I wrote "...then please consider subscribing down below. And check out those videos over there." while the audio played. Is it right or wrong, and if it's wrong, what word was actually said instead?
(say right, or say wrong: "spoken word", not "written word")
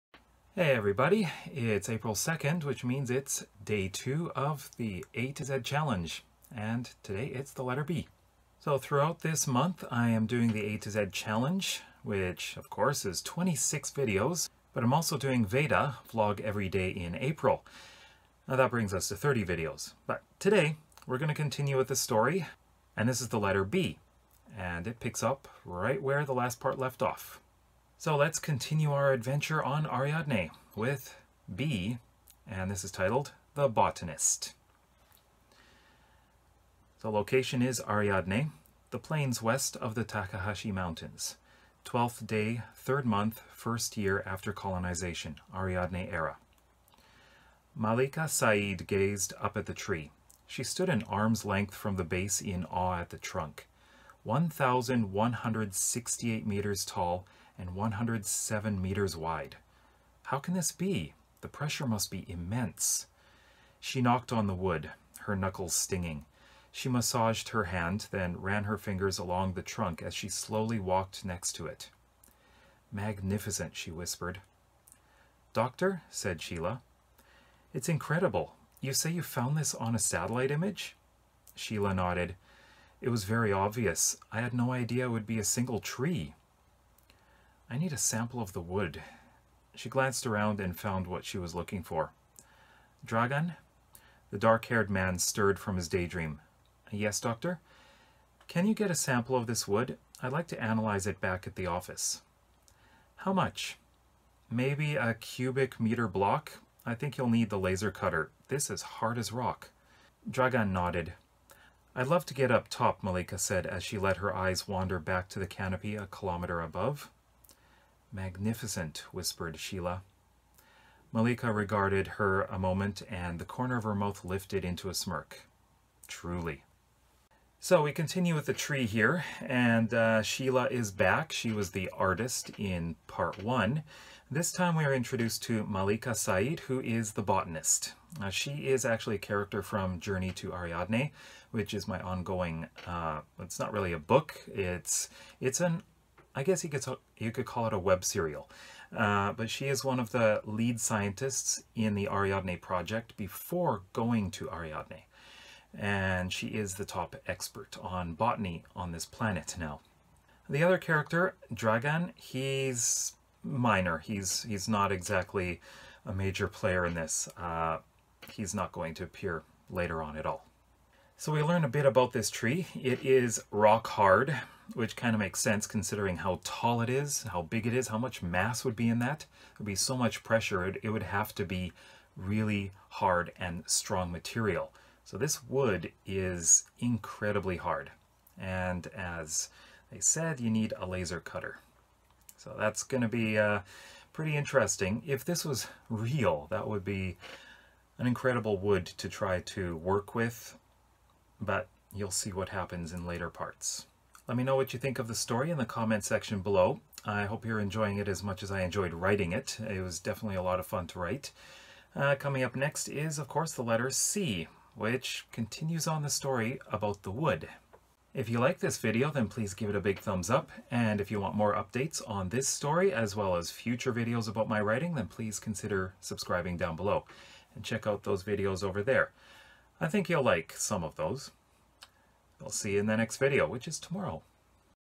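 right.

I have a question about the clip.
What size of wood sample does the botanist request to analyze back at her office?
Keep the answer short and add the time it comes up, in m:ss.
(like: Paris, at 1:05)
A cubic meter block, at 1:44.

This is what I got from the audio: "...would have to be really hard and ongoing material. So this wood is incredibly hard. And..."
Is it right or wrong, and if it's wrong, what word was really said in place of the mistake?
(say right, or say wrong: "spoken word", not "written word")
wrong: "strong", not "ongoing".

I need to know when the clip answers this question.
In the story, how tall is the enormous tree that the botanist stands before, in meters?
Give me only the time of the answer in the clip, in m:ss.
0:54.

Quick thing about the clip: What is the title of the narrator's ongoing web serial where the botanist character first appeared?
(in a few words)
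Journey to Ariadne.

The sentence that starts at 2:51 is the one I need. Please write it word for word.
So we learn a bit about this tree.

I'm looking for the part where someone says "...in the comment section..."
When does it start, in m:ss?
3:25.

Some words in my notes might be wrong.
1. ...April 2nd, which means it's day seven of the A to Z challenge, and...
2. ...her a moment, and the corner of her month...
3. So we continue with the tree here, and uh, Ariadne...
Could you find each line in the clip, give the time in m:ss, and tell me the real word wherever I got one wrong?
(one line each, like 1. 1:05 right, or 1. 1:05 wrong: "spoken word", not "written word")
1. 0:01 wrong: "two", not "seven"
2. 2:02 wrong: "mouth", not "month"
3. 2:07 wrong: "Sheila", not "Ariadne".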